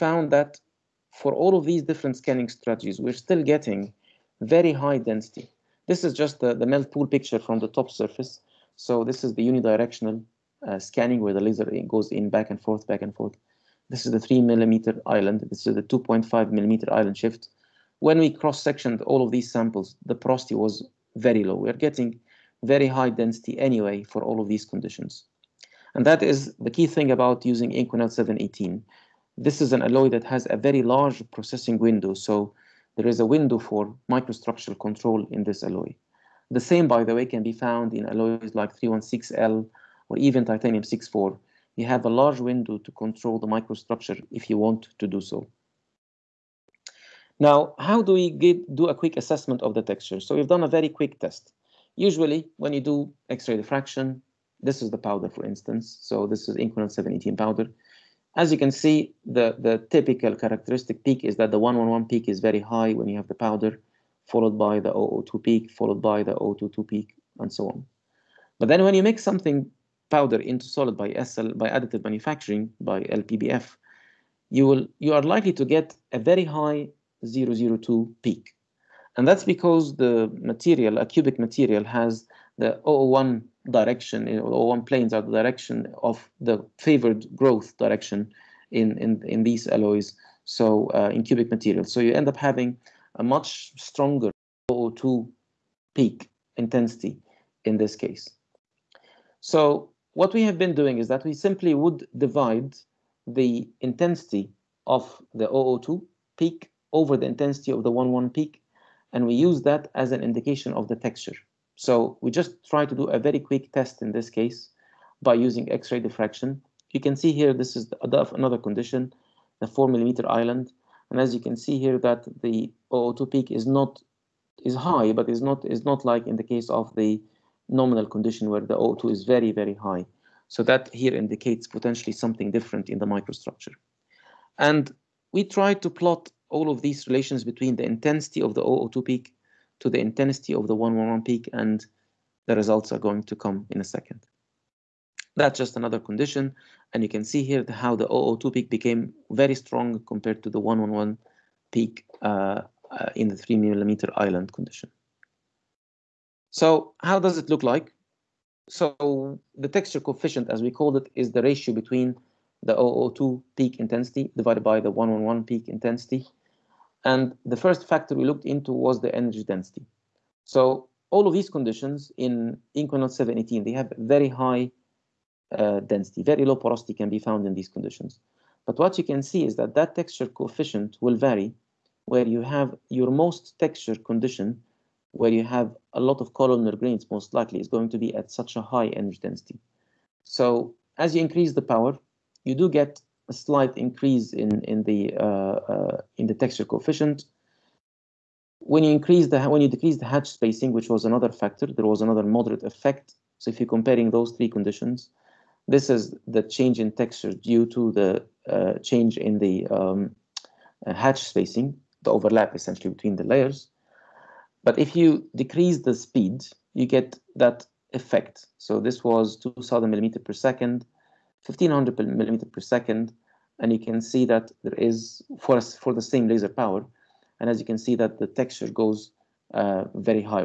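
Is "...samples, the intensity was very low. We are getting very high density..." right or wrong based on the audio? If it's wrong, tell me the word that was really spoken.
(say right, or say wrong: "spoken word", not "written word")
wrong: "porosity", not "intensity".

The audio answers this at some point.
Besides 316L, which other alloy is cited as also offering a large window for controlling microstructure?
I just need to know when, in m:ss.
0:40.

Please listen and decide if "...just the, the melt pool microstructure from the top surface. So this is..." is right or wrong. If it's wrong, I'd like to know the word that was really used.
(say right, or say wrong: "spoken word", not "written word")
wrong: "picture", not "microstructure".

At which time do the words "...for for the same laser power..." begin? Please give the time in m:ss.
3:45.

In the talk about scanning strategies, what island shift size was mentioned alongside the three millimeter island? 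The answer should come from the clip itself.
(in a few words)
2.5 millimeter.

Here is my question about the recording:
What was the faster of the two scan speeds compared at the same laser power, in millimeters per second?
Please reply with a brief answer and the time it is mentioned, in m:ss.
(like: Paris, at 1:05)
2000, at 3:39.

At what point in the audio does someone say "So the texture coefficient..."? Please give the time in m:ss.
2:38.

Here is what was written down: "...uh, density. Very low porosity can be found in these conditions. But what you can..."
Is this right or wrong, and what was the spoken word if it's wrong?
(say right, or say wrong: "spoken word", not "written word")
right.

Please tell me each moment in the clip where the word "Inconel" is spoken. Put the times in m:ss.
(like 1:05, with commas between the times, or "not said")
0:27, 0:56, 2:52.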